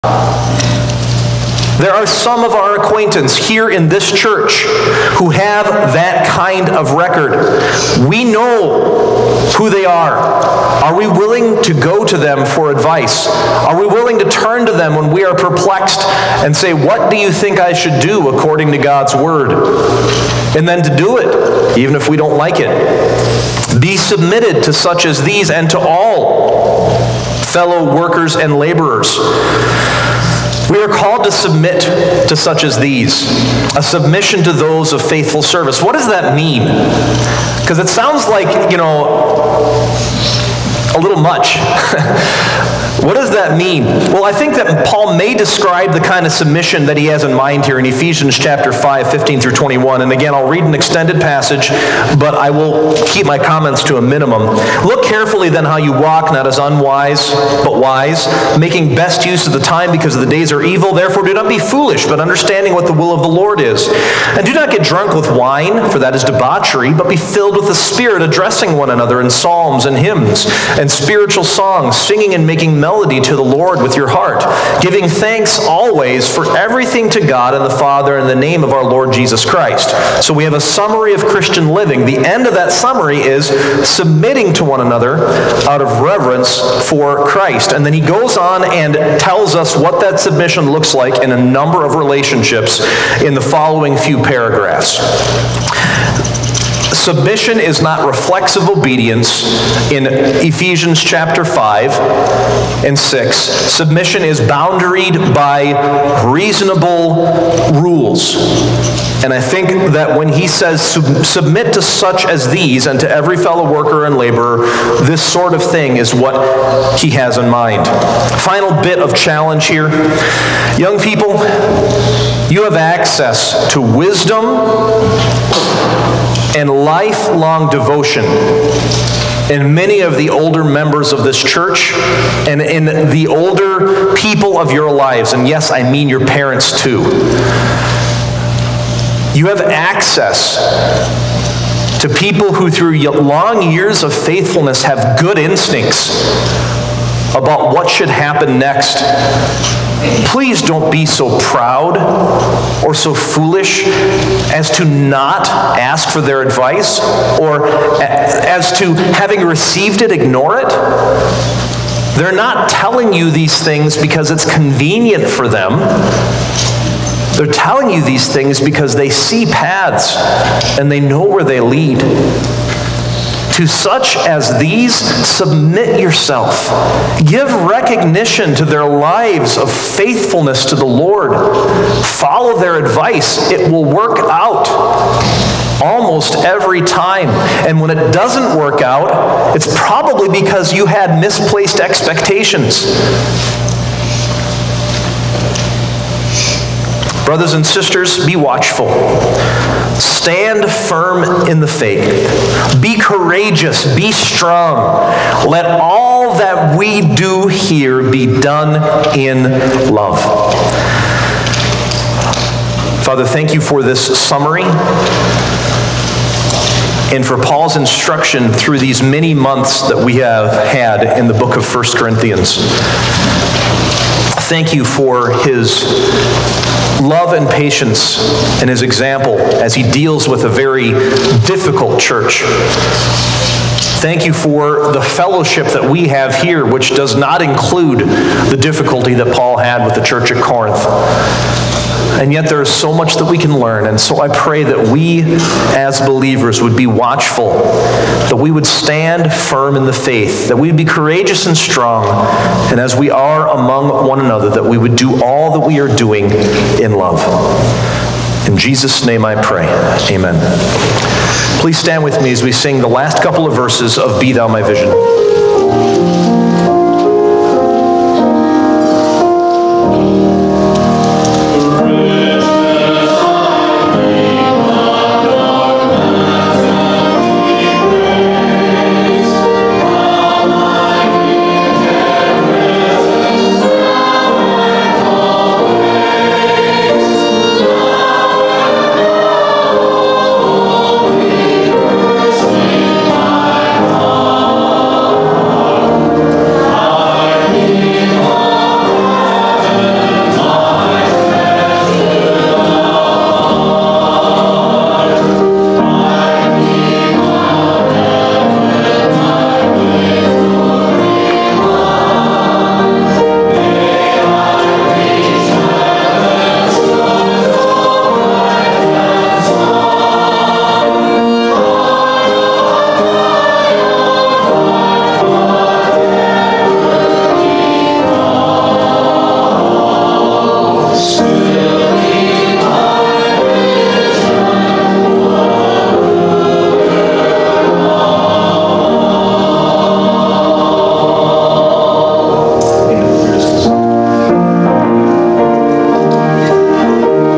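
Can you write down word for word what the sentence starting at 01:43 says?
Submission is boundaried by reasonable rules.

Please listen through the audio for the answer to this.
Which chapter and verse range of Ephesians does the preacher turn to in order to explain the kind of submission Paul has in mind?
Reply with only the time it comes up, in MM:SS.
00:47.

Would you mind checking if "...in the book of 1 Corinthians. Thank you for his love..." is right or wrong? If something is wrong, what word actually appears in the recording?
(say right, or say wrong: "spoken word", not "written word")
right.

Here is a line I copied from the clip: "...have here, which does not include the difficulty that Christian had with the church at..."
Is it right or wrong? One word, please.
wrong.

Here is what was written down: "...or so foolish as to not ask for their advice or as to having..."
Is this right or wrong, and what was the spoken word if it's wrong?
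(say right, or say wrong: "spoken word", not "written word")
right.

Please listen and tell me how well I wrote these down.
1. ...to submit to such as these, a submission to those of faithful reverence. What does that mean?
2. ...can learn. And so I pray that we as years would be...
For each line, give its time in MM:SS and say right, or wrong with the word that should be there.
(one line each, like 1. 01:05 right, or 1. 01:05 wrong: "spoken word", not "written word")
1. 00:31 wrong: "service", not "reverence"
2. 04:03 wrong: "believers", not "years".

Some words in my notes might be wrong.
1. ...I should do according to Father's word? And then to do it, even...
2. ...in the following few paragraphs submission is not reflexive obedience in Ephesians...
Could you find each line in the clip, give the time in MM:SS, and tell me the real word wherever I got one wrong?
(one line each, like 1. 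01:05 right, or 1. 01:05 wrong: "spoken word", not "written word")
1. 00:17 wrong: "God", not "Father"
2. 01:33 right.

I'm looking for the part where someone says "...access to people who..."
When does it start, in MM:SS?
02:19.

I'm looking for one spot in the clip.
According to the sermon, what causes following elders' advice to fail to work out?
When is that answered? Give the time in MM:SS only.
03:11.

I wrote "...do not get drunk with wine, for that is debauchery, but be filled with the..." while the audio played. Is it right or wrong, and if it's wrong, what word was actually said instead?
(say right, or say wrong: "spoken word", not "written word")
right.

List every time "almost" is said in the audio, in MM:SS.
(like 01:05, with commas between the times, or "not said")
03:05.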